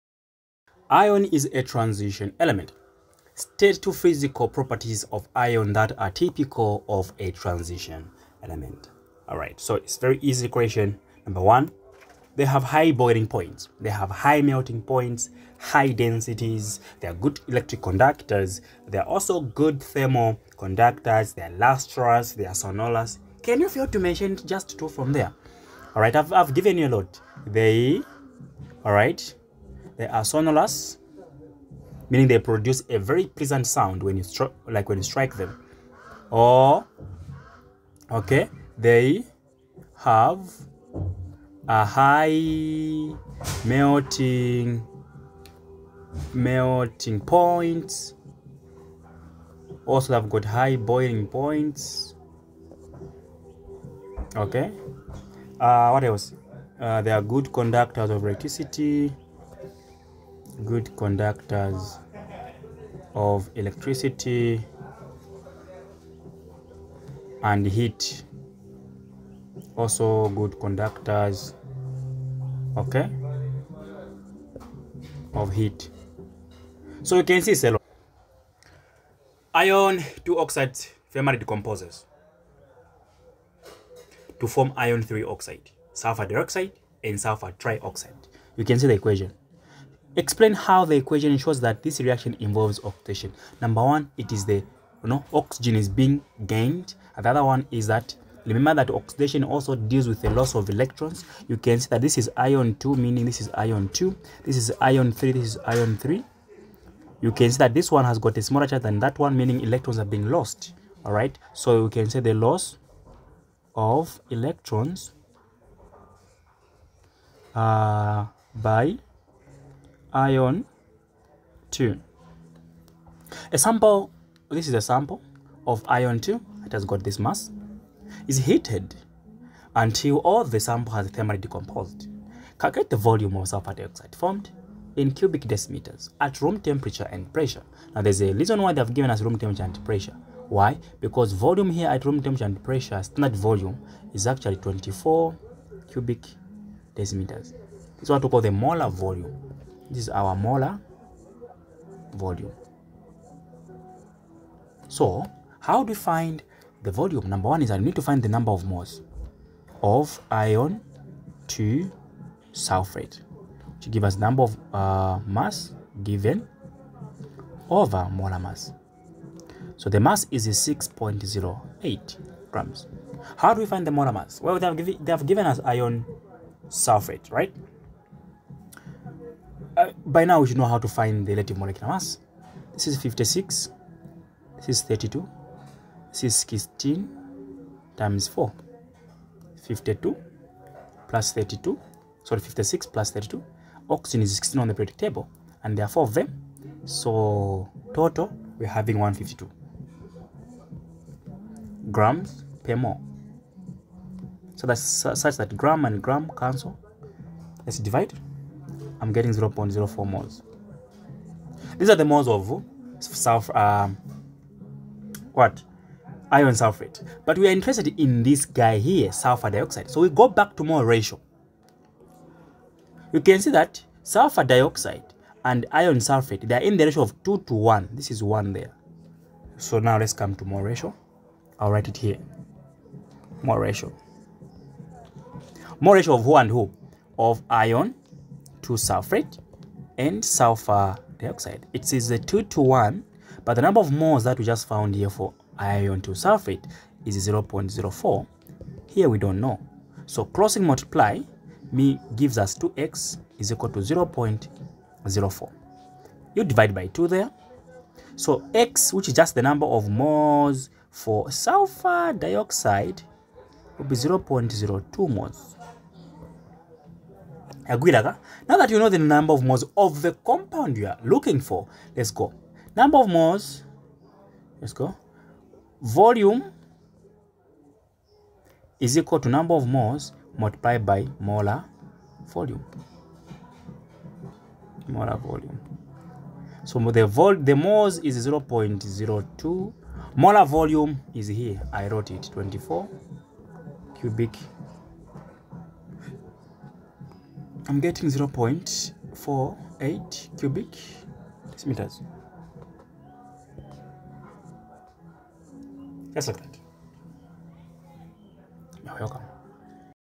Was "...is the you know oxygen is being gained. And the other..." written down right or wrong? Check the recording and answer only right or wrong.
right.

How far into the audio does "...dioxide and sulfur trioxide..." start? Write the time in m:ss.
1:26.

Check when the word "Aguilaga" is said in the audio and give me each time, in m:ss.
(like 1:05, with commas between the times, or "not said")
4:27.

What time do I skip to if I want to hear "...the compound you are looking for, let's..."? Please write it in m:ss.
4:30.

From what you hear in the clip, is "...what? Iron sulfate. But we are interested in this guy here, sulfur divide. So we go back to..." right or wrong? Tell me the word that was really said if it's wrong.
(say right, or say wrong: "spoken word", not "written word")
wrong: "dioxide", not "divide".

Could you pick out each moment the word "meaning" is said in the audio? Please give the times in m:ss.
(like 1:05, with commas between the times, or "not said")
0:32, 1:42, 1:49.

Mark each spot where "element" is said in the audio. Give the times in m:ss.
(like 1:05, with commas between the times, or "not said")
0:02, 0:08.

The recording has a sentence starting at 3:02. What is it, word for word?
This is 56, this is 32, this is 16 times 4, 52 plus 32, sorry 56 plus 32.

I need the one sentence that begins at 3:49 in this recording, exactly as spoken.
So now let's come to mole ratio.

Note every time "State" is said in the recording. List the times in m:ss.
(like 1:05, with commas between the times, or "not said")
0:03.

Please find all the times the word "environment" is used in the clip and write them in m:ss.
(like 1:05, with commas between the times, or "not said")
not said.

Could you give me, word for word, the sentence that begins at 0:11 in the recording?
Number one, they have high boiling points.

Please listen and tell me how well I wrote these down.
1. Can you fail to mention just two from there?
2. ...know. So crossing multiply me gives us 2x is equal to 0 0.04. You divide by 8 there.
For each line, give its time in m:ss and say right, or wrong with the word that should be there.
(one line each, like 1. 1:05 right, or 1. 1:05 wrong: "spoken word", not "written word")
1. 0:23 right
2. 4:09 wrong: "2", not "8".